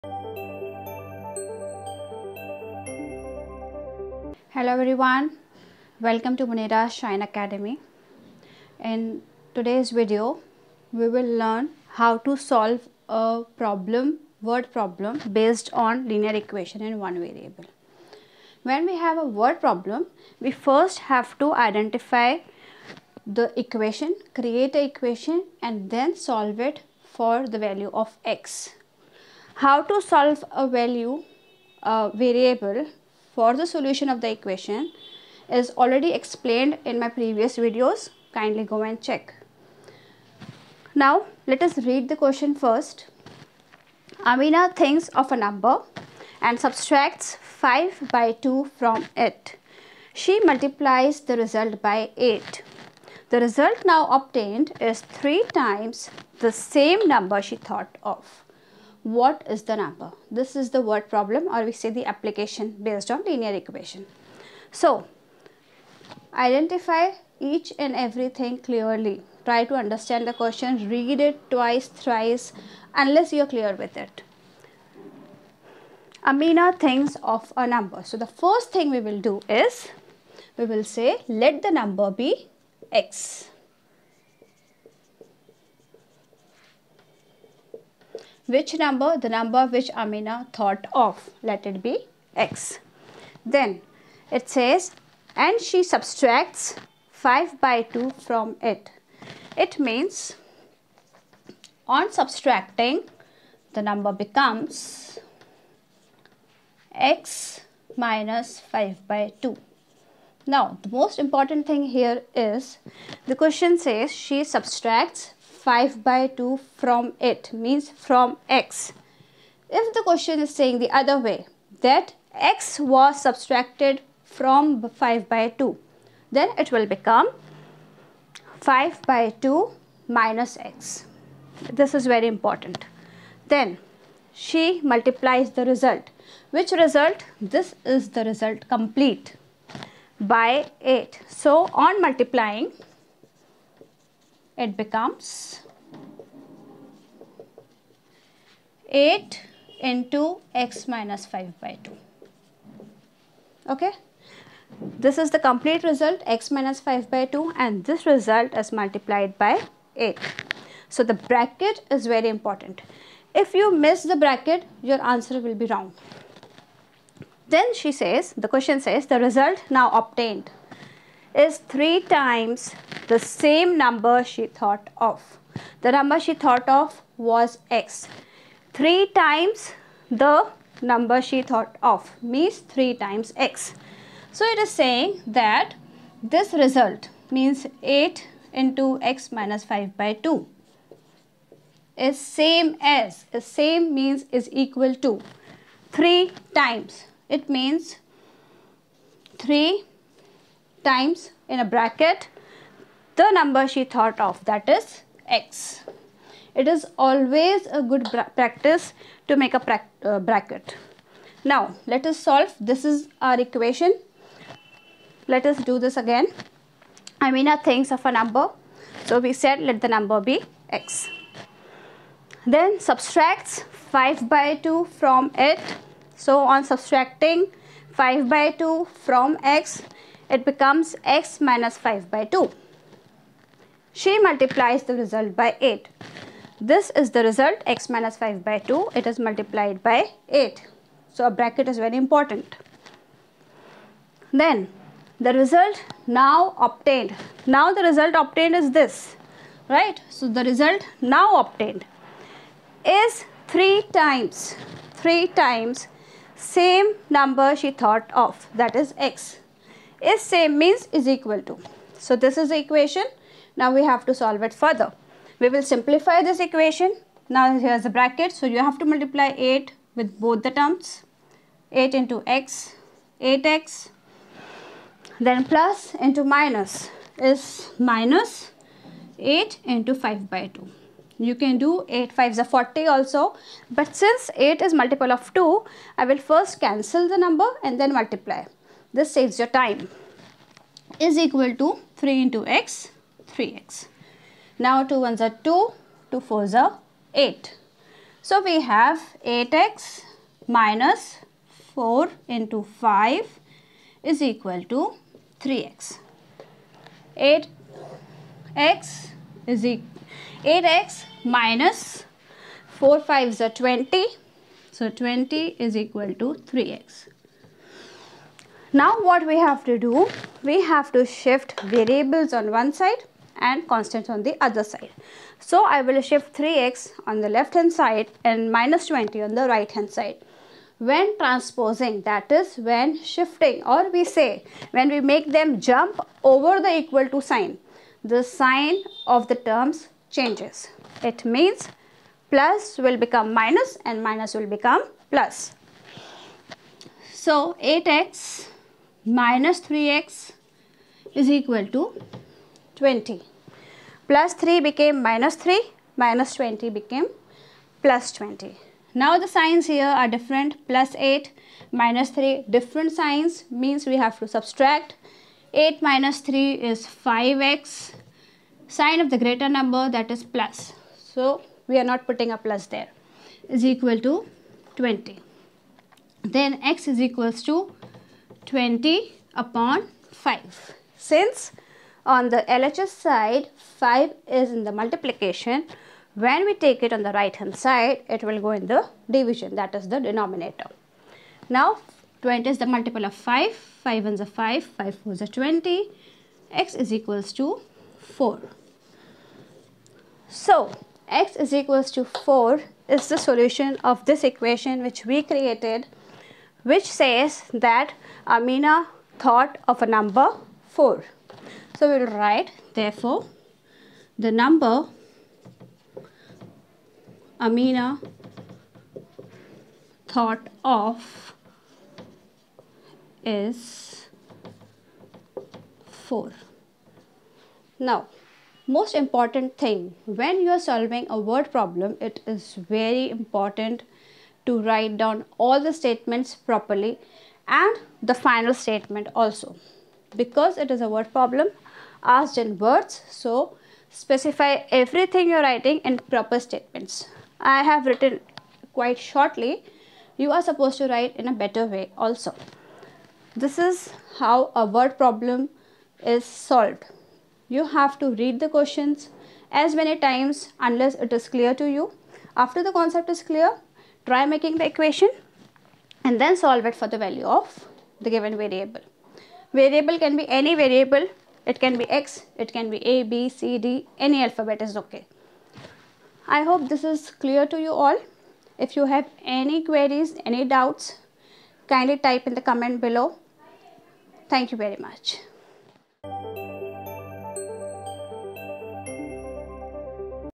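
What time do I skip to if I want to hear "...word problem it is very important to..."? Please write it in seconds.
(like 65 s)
431 s.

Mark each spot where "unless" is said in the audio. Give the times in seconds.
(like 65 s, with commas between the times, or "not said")
72 s, 460 s.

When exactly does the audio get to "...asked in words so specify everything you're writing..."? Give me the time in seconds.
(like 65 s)
442 s.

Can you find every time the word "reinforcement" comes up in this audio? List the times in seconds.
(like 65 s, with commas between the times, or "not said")
not said.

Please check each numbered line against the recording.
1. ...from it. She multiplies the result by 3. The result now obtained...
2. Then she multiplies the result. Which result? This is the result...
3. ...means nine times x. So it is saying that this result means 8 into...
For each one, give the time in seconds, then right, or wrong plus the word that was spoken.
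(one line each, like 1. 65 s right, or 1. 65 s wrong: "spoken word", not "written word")
1. 48 s wrong: "8", not "3"
2. 133 s right
3. 182 s wrong: "three", not "nine".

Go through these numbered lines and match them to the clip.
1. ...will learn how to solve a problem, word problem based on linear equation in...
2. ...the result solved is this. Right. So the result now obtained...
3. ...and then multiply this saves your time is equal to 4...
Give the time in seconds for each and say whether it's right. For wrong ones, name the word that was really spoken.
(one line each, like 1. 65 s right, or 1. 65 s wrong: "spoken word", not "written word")
1. 11 s right
2. 247 s wrong: "obtained", not "solved"
3. 287 s wrong: "3", not "4".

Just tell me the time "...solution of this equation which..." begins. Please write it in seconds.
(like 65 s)
403 s.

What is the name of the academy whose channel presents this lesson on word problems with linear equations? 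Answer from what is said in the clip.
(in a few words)
Munira Shine Academy.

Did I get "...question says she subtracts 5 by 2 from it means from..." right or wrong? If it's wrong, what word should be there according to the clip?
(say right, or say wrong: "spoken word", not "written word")
right.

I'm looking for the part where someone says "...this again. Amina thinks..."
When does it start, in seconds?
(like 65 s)
215 s.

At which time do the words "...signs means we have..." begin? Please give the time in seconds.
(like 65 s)
362 s.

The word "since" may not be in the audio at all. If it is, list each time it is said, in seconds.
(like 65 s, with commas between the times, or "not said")
283 s, 380 s.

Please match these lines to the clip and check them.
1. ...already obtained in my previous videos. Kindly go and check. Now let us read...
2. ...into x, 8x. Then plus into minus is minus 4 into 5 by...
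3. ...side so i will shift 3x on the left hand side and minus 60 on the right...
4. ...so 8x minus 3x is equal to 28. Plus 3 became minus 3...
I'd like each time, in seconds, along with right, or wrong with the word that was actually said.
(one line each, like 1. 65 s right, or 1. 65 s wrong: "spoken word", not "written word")
1. 35 s wrong: "explained", not "obtained"
2. 271 s wrong: "8", not "4"
3. 324 s wrong: "20", not "60"
4. 347 s wrong: "20", not "28".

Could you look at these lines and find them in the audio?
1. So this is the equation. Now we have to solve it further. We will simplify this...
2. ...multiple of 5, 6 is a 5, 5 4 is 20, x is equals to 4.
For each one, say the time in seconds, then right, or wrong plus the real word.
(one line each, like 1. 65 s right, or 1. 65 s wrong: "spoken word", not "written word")
1. 261 s right
2. 392 s wrong: "5", not "6".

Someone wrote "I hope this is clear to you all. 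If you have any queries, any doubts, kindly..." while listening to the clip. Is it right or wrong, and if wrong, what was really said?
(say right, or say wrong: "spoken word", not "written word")
right.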